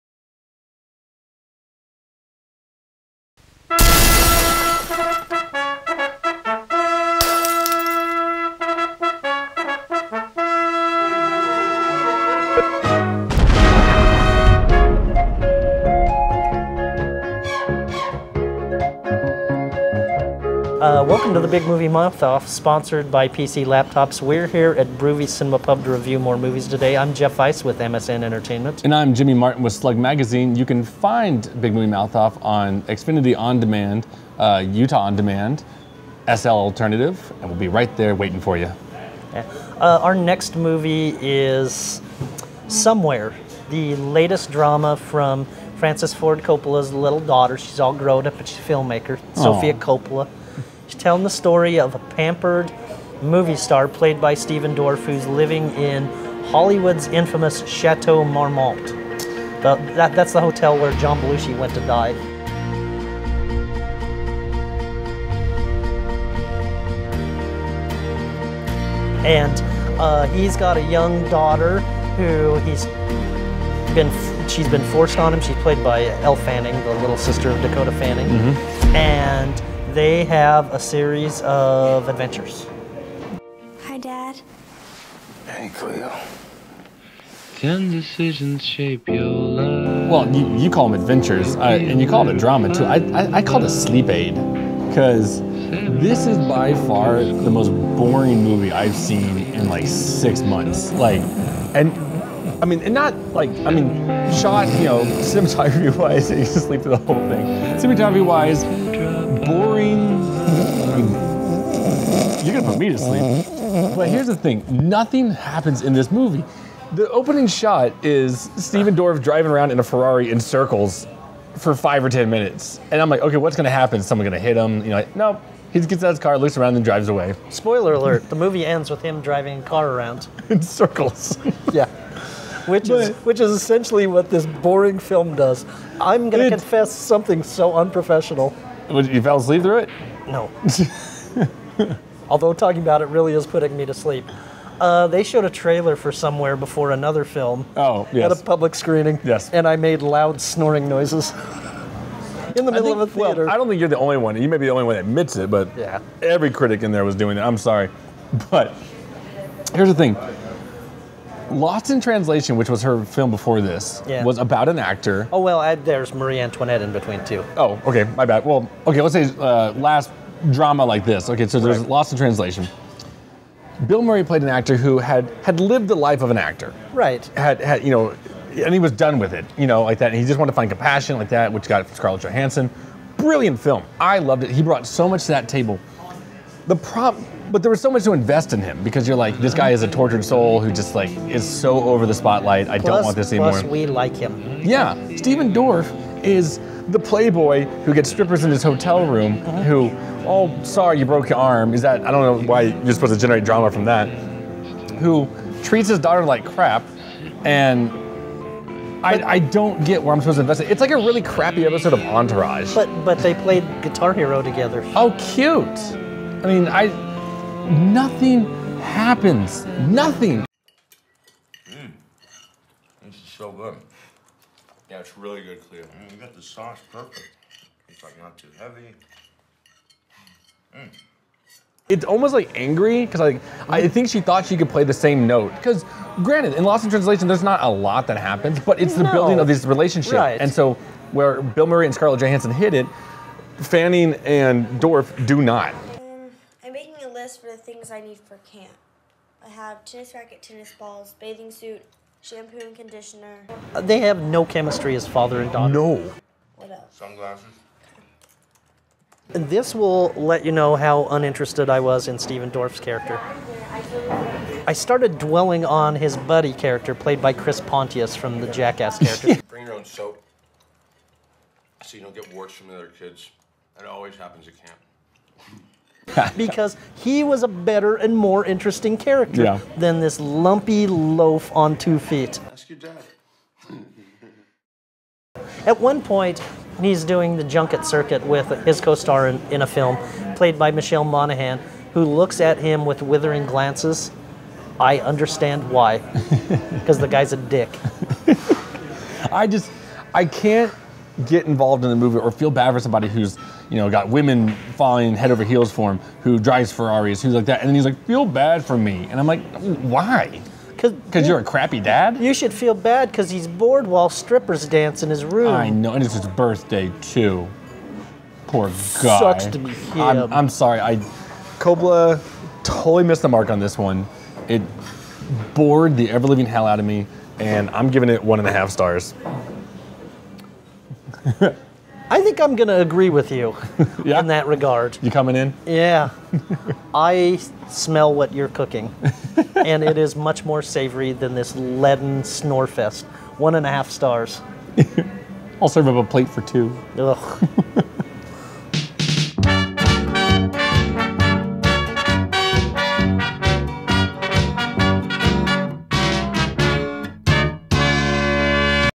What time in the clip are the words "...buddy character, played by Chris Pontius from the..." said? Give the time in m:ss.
4:26.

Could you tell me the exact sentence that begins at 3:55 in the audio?
Because granted, in Lost in Translation, there's not a lot that happens, but it's the no.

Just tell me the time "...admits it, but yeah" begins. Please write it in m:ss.
2:35.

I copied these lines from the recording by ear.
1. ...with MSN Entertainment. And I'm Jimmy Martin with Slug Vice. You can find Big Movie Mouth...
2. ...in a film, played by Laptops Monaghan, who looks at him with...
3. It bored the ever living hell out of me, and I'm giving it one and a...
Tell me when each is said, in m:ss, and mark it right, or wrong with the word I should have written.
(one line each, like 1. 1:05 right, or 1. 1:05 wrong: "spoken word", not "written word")
1. 0:27 wrong: "Magazine", not "Vice"
2. 4:49 wrong: "Michelle", not "Laptops"
3. 5:24 right.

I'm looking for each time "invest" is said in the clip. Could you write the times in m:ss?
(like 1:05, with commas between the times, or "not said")
3:08, 3:30.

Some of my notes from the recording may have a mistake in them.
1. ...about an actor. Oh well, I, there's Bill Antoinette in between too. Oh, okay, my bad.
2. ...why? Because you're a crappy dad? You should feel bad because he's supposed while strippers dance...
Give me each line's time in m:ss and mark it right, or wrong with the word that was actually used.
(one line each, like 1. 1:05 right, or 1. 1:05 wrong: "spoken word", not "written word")
1. 2:44 wrong: "Marie", not "Bill"
2. 5:09 wrong: "bored", not "supposed".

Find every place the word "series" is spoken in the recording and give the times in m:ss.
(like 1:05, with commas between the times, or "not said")
1:20.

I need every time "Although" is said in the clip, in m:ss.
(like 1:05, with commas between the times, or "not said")
2:22.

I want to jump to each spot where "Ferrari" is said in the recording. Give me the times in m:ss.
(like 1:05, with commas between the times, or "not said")
1:59, 5:06.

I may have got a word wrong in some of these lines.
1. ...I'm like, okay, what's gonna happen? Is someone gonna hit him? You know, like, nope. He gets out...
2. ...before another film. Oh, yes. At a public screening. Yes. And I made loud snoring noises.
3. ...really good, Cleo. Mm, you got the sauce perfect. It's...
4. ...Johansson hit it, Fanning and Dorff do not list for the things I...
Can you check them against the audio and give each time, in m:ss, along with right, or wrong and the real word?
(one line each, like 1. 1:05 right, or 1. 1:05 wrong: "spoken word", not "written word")
1. 2:03 right
2. 2:26 right
3. 3:45 right
4. 4:02 right.